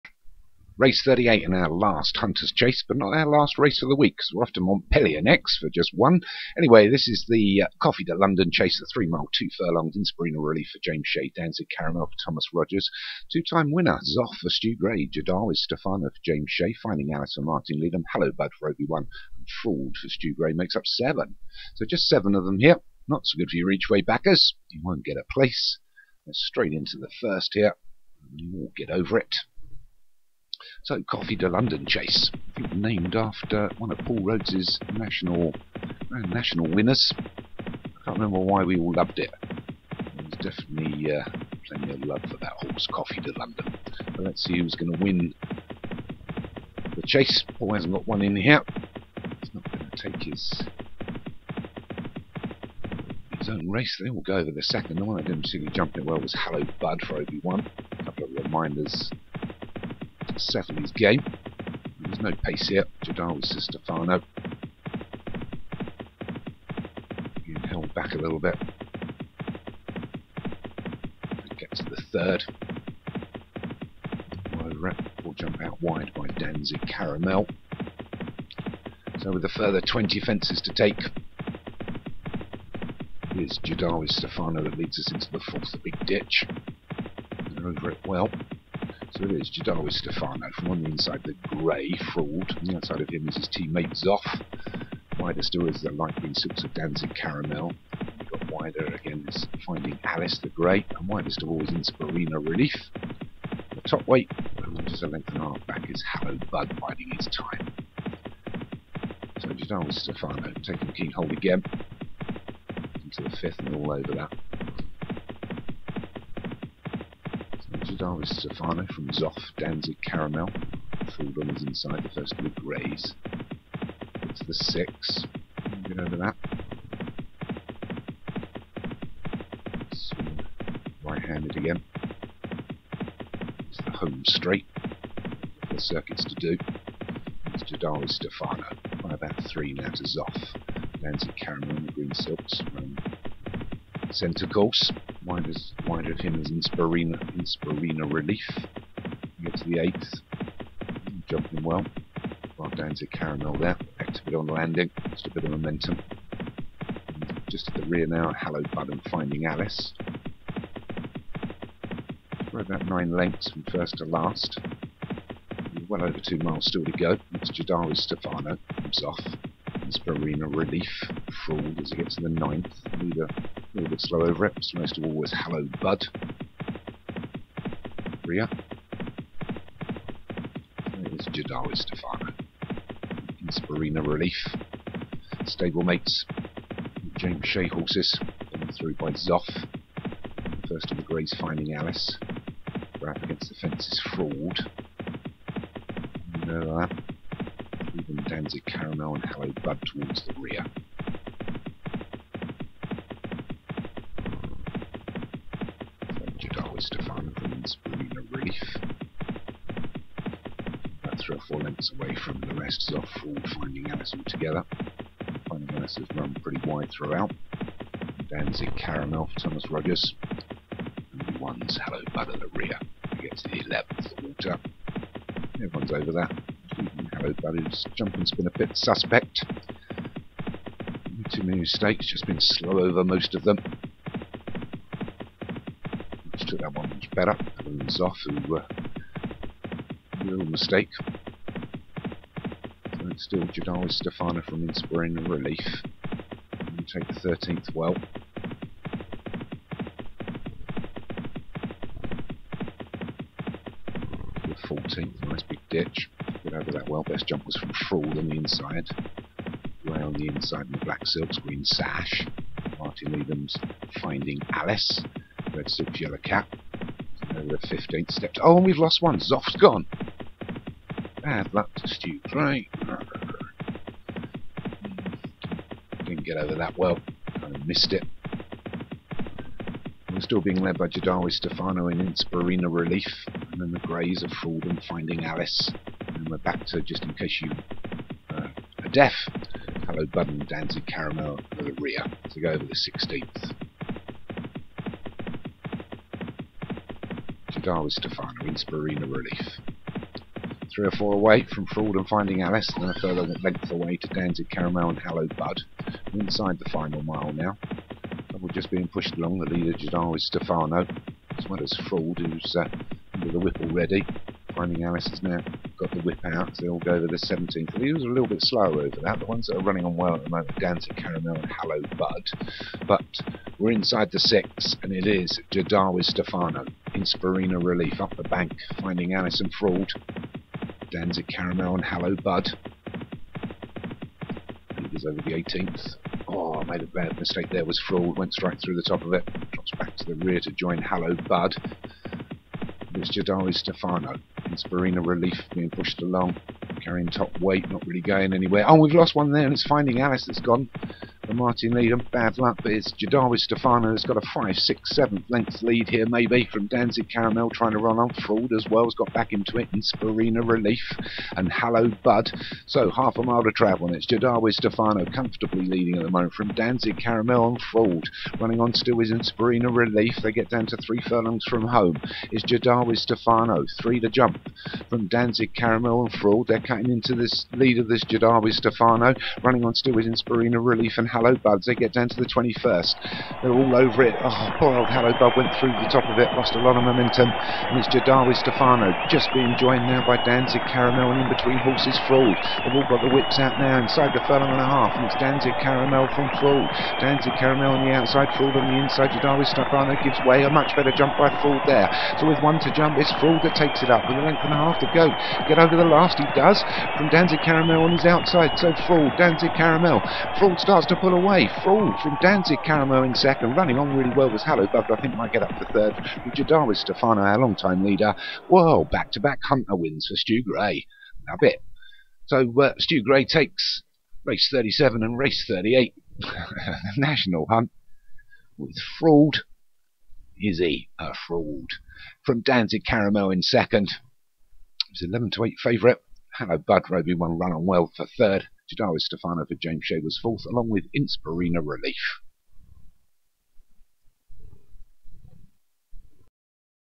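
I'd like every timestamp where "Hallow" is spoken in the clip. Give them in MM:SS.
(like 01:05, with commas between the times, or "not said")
01:46, 05:31, 05:40, 06:01, 06:21, 06:54.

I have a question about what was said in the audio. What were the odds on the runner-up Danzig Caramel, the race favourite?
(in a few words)
11 to 8.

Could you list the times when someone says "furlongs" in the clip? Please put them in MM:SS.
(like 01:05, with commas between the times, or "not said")
00:09, 06:11, 06:34.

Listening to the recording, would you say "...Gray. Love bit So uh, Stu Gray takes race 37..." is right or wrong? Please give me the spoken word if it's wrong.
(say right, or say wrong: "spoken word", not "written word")
right.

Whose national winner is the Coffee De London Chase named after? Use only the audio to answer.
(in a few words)
Paul Rhodes.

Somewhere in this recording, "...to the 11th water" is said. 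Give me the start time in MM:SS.
03:43.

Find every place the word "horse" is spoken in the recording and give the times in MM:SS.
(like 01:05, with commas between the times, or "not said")
00:42, 03:07, 06:31.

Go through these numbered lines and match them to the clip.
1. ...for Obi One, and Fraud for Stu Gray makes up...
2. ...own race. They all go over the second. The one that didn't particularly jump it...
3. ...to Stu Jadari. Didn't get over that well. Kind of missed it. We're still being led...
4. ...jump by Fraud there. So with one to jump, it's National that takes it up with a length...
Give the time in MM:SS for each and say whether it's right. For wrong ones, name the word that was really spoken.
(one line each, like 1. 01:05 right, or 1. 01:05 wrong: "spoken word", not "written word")
1. 00:18 right
2. 00:53 right
3. 04:31 wrong: "Gray", not "Jadari"
4. 06:40 wrong: "Fraud", not "National".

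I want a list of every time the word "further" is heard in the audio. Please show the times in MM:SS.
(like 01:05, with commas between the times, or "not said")
01:19, 05:02.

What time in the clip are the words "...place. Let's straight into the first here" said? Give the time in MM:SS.
00:25.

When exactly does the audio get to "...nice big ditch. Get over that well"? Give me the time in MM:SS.
04:15.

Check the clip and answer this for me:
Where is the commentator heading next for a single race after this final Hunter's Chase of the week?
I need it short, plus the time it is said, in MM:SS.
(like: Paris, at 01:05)
Montpellier, at 00:04.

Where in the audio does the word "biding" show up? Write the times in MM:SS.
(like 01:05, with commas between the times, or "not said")
01:46.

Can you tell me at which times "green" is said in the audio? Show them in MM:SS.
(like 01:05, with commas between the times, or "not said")
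01:36, 02:21, 04:21.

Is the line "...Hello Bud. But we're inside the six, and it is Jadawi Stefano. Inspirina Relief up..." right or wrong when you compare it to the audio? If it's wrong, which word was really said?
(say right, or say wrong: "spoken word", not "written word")
right.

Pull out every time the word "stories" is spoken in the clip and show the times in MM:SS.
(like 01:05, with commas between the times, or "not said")
01:41.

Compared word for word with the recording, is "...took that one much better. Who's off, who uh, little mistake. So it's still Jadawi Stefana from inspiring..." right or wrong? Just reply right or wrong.
right.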